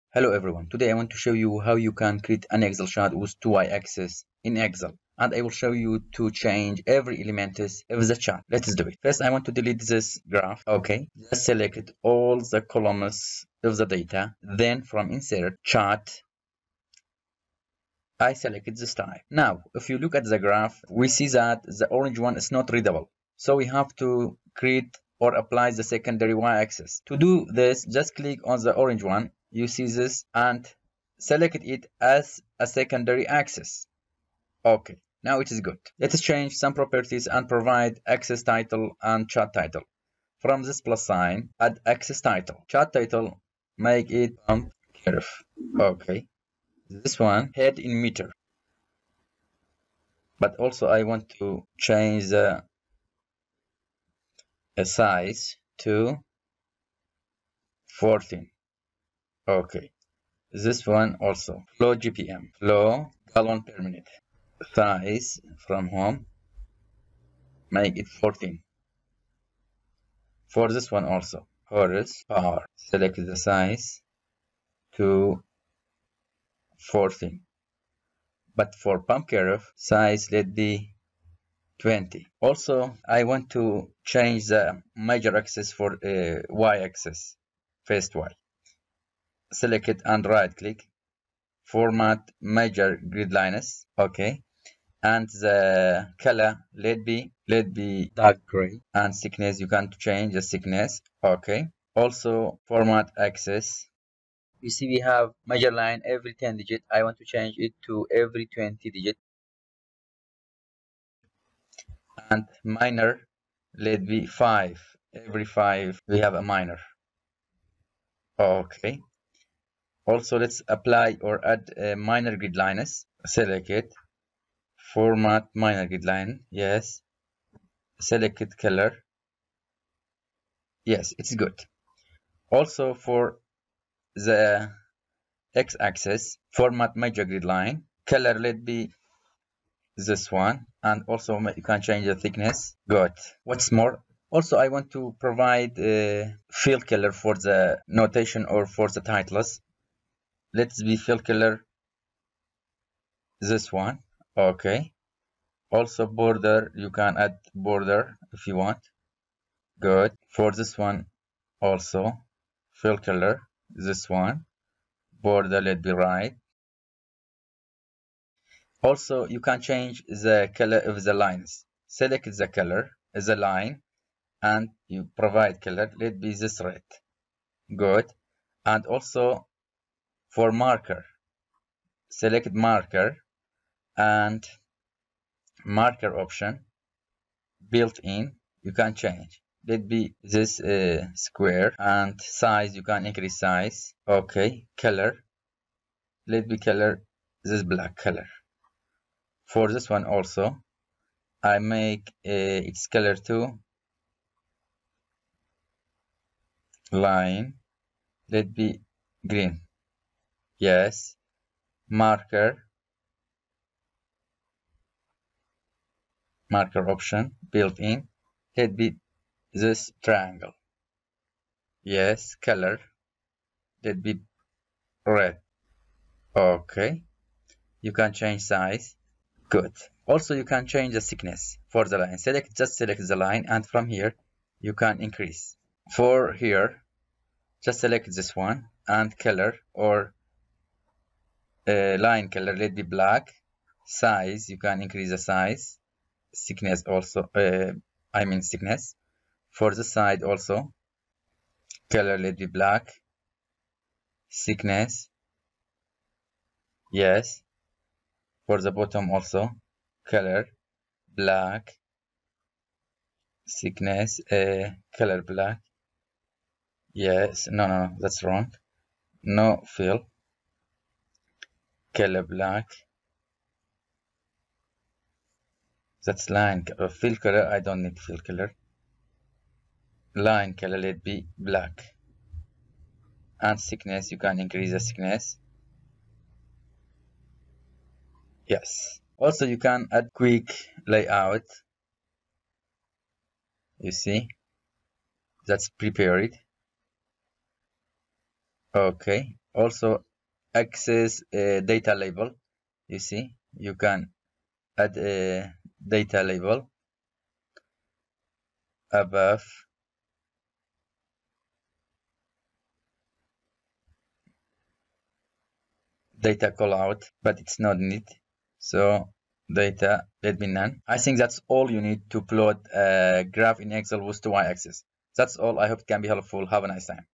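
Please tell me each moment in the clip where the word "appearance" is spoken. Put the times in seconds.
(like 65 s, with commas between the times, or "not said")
not said.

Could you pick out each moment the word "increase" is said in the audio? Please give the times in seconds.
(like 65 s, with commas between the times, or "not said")
193 s, 235 s, 244 s, 284 s.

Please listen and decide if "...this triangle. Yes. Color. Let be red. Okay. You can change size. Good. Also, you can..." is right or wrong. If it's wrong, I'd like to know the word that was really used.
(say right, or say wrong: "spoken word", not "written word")
right.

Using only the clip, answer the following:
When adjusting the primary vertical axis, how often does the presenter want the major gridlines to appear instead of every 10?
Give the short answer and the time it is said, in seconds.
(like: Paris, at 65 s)
Every 20, at 108 s.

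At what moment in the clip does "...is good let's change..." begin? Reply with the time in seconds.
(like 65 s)
35 s.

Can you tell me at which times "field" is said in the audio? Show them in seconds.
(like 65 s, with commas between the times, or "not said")
146 s.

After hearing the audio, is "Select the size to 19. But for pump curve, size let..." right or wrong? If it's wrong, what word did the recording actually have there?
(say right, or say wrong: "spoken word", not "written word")
wrong: "14", not "19".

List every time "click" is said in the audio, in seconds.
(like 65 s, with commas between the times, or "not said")
28 s, 90 s.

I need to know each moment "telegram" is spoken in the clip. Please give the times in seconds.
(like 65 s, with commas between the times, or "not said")
not said.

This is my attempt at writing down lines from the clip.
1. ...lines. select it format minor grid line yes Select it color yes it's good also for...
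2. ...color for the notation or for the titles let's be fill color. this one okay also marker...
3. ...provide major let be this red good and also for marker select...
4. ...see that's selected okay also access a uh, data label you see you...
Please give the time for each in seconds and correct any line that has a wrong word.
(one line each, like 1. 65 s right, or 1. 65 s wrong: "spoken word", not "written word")
1. 122 s right
2. 146 s wrong: "border", not "marker"
3. 175 s wrong: "color", not "major"
4. 293 s wrong: "prepared", not "selected".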